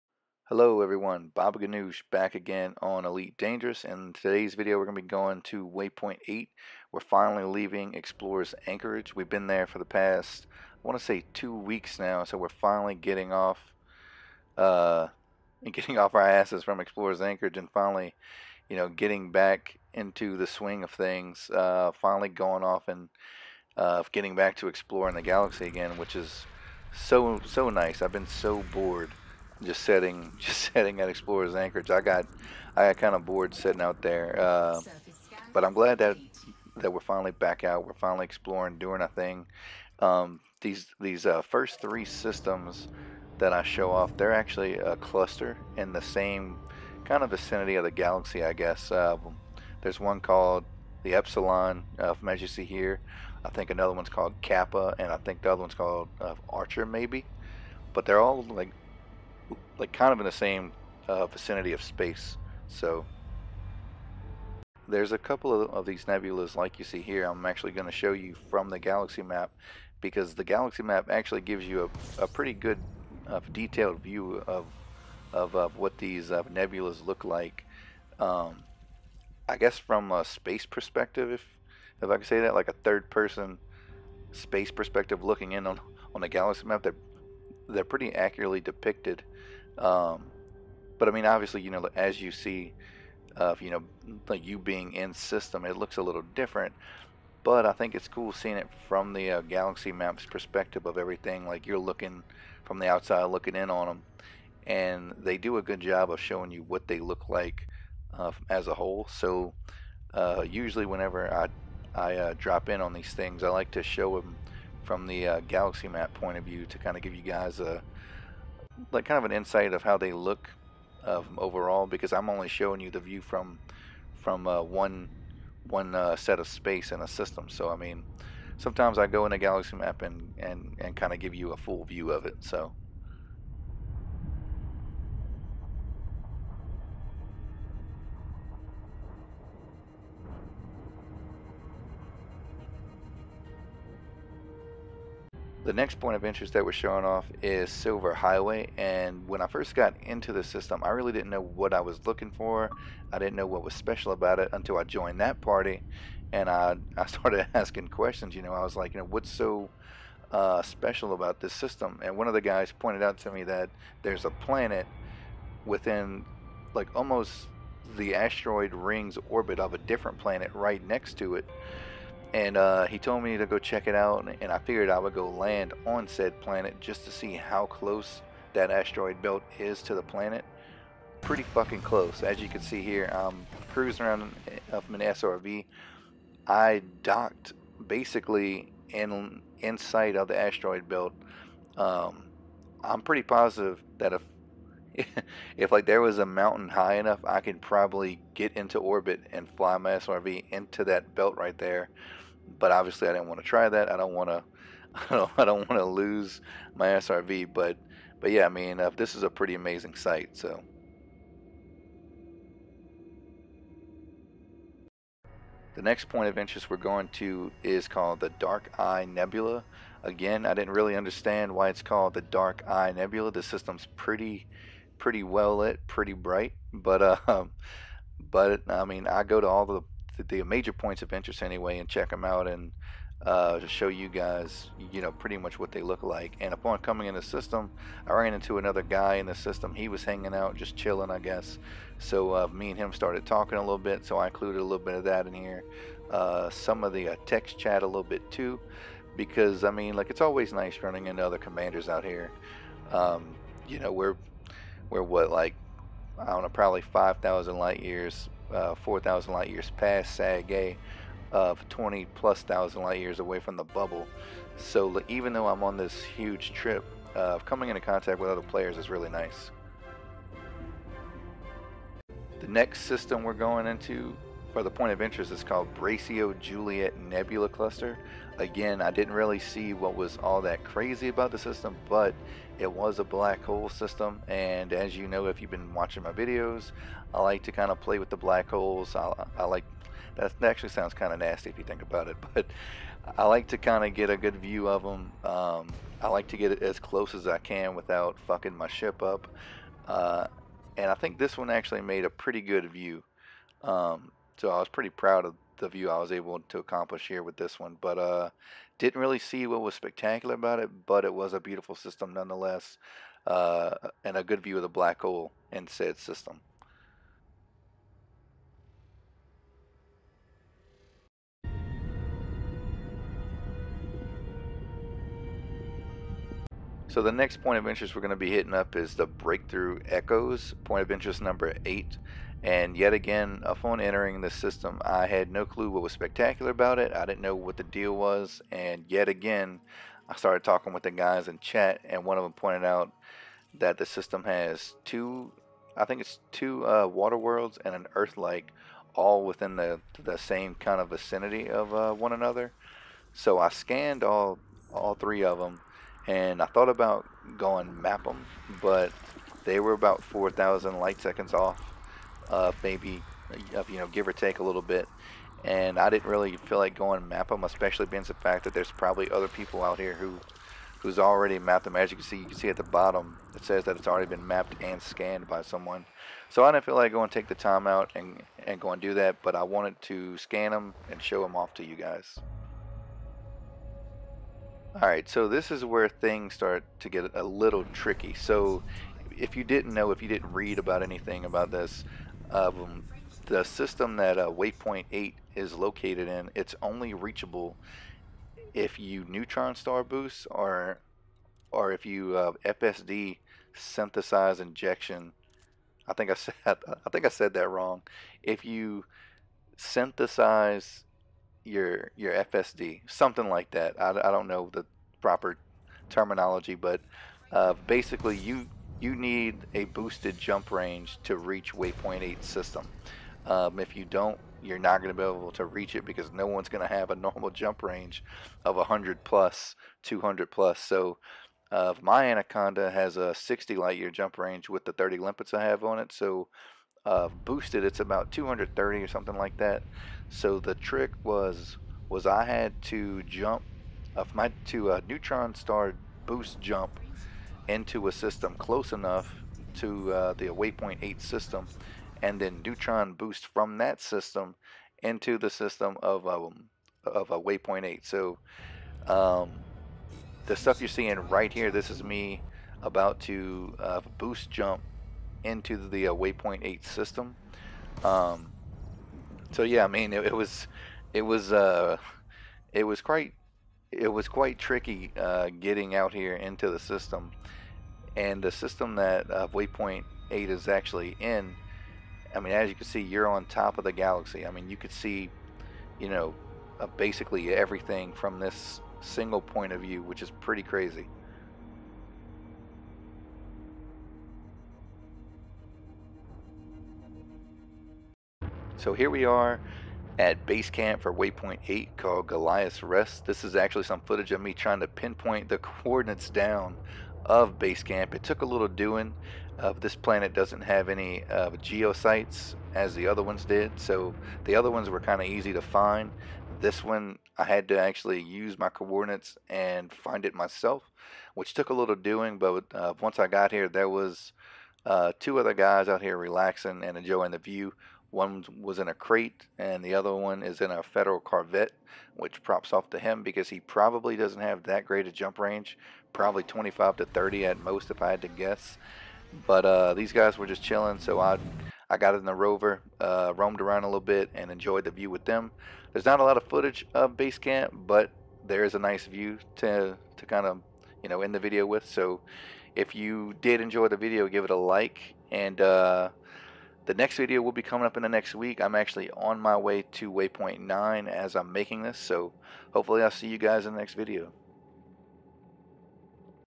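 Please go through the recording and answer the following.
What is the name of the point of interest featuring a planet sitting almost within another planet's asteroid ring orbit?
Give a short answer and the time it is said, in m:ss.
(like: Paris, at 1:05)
Silver Highway, at 2:27.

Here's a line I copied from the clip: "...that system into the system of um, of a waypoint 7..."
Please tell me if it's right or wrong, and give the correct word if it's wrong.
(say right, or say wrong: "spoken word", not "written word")
wrong: "8", not "7".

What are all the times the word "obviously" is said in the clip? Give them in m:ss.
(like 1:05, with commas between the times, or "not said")
1:31, 3:22.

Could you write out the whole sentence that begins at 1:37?
But I think it's cool seeing it from the uh, galaxy maps perspective of everything.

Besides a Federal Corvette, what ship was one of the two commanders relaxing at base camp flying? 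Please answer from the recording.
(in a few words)
Krait.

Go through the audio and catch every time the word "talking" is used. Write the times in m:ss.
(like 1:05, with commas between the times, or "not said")
4:03, 5:40.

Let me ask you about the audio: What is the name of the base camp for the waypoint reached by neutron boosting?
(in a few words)
Goliath's Rest.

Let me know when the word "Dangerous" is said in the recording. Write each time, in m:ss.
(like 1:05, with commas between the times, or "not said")
0:03.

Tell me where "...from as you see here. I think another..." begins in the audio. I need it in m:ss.
0:52.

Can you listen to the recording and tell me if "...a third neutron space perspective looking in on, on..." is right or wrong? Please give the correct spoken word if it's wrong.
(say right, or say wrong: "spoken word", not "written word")
wrong: "person", not "neutron".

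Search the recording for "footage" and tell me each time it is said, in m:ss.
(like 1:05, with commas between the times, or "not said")
8:23, 9:06.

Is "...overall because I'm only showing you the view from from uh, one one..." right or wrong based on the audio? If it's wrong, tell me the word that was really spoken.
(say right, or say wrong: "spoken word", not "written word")
right.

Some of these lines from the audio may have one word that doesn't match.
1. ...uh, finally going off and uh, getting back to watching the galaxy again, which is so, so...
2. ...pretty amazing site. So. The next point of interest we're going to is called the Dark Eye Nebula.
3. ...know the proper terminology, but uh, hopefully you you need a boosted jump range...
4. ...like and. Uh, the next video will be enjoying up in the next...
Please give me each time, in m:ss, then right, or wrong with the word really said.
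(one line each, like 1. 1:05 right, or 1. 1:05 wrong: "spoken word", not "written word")
1. 0:21 wrong: "exploring", not "watching"
2. 3:29 right
3. 6:54 wrong: "basically", not "hopefully"
4. 9:14 wrong: "coming", not "enjoying".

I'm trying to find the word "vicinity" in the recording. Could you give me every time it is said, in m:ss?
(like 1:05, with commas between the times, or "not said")
0:47, 1:01, 5:50.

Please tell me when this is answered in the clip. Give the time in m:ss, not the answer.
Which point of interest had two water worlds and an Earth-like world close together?
5:29.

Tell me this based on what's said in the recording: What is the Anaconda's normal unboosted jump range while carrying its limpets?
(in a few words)
60 light years.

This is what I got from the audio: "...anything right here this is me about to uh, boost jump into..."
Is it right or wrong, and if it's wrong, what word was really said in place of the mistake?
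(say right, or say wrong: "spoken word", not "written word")
wrong: "seeing", not "anything".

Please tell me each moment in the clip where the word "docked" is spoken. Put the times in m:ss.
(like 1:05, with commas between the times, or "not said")
3:07.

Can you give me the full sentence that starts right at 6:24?
All right, so this is where things start to get a little tricky.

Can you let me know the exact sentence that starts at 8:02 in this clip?
I mean, as you can see, you're on top of the galaxy.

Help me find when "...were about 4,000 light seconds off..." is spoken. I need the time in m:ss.
5:59.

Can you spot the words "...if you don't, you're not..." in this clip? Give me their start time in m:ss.
7:03.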